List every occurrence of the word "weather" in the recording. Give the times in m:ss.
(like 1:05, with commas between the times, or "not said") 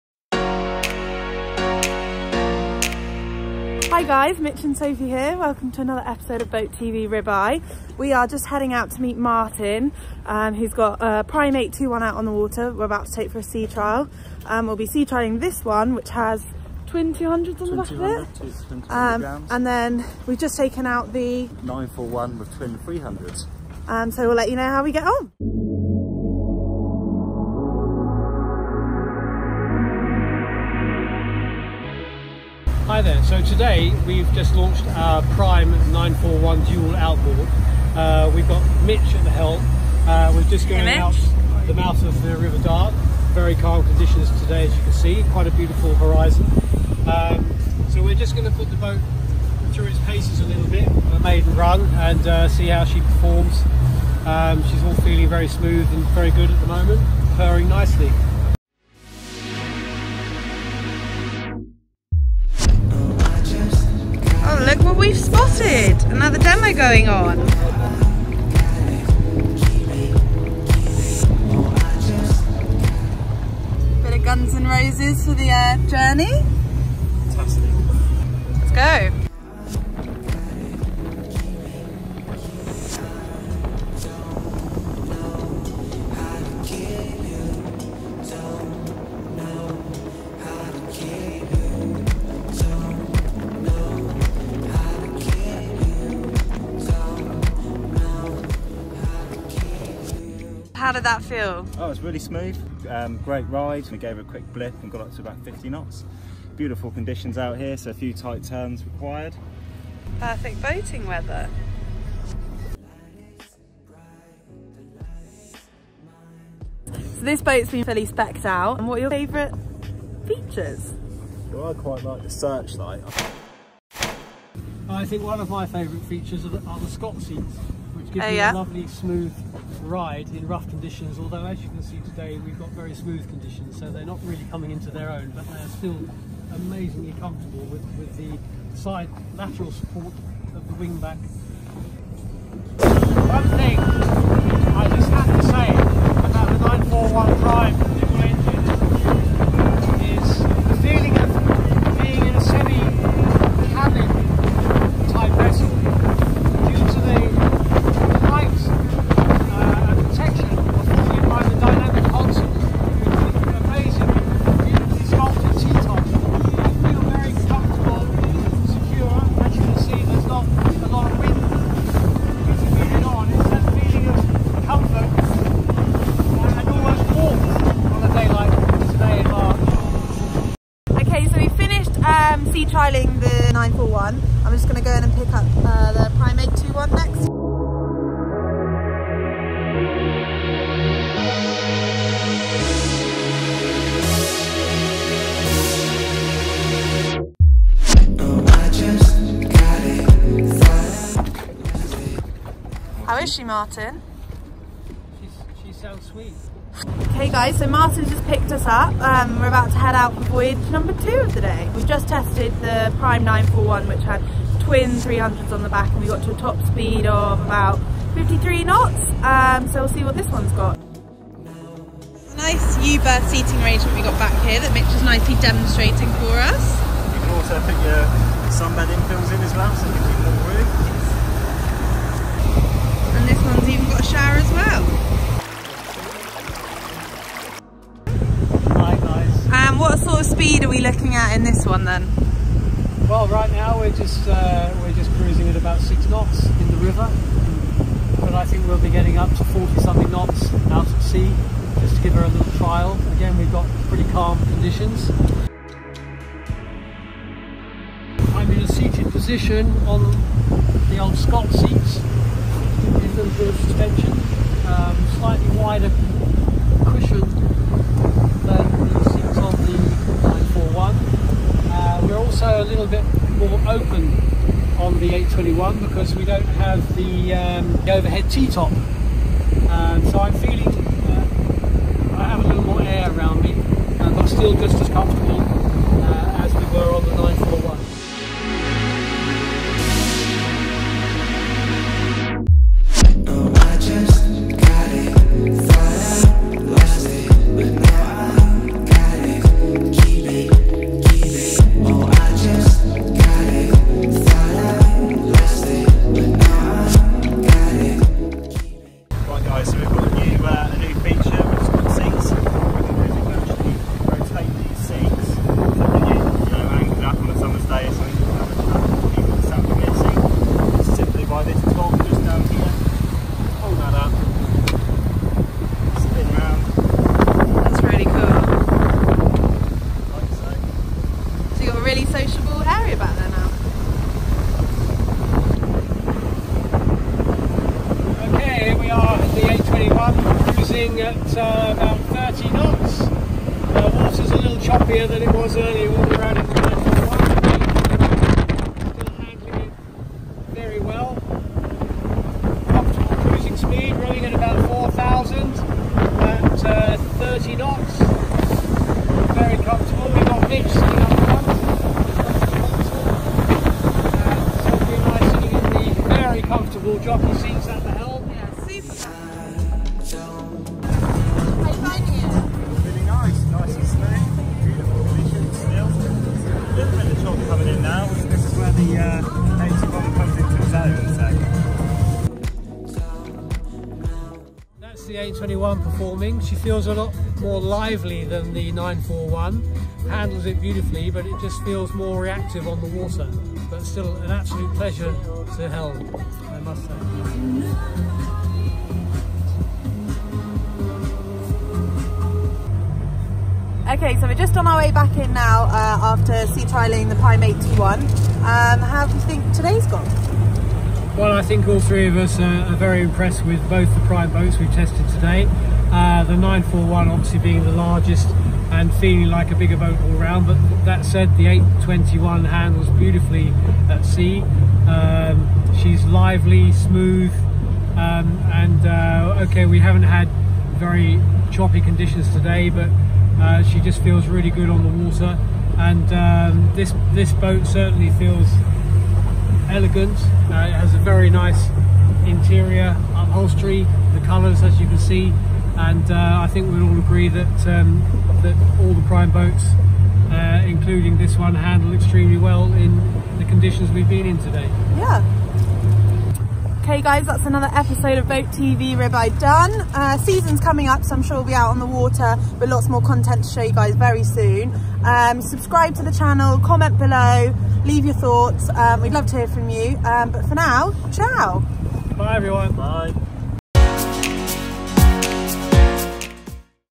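1:51.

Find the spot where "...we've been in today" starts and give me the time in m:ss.
7:33.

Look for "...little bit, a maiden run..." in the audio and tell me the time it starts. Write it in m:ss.
0:50.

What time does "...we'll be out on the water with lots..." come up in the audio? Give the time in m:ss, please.
7:41.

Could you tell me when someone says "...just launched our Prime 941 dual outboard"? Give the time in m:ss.
0:34.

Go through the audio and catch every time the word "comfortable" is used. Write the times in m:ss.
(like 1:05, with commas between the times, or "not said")
2:17, 5:59.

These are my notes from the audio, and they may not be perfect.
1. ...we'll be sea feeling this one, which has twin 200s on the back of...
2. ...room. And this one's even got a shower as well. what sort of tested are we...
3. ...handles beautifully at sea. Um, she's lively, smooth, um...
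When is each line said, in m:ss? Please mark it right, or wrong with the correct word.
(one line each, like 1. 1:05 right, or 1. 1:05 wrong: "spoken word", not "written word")
1. 0:14 wrong: "trialing", not "feeling"
2. 3:50 wrong: "speed", not "tested"
3. 7:02 right.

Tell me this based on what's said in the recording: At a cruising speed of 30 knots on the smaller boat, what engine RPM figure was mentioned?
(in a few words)
4,000.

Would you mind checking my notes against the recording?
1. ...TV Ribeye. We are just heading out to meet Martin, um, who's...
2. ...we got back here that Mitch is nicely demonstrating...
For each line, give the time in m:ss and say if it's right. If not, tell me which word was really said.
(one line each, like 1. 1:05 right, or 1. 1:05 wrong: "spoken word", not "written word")
1. 0:06 right
2. 3:43 right.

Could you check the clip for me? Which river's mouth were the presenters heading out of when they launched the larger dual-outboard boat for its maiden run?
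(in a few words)
River Dart.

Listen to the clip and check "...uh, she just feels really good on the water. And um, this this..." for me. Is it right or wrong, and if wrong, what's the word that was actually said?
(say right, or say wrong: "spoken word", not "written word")
right.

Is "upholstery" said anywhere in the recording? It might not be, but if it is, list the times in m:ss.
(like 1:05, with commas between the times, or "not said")
7:23.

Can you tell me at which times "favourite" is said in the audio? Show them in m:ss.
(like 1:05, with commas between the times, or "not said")
1:59, 2:05.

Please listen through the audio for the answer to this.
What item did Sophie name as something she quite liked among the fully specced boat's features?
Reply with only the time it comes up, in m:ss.
2:02.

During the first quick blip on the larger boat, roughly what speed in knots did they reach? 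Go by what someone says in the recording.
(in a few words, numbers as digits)
50 knots.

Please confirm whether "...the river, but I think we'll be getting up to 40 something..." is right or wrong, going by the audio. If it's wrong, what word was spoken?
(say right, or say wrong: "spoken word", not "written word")
right.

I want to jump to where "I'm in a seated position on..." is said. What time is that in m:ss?
4:18.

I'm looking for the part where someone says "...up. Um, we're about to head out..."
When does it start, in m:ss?
3:28.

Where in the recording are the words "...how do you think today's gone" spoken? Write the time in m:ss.
6:48.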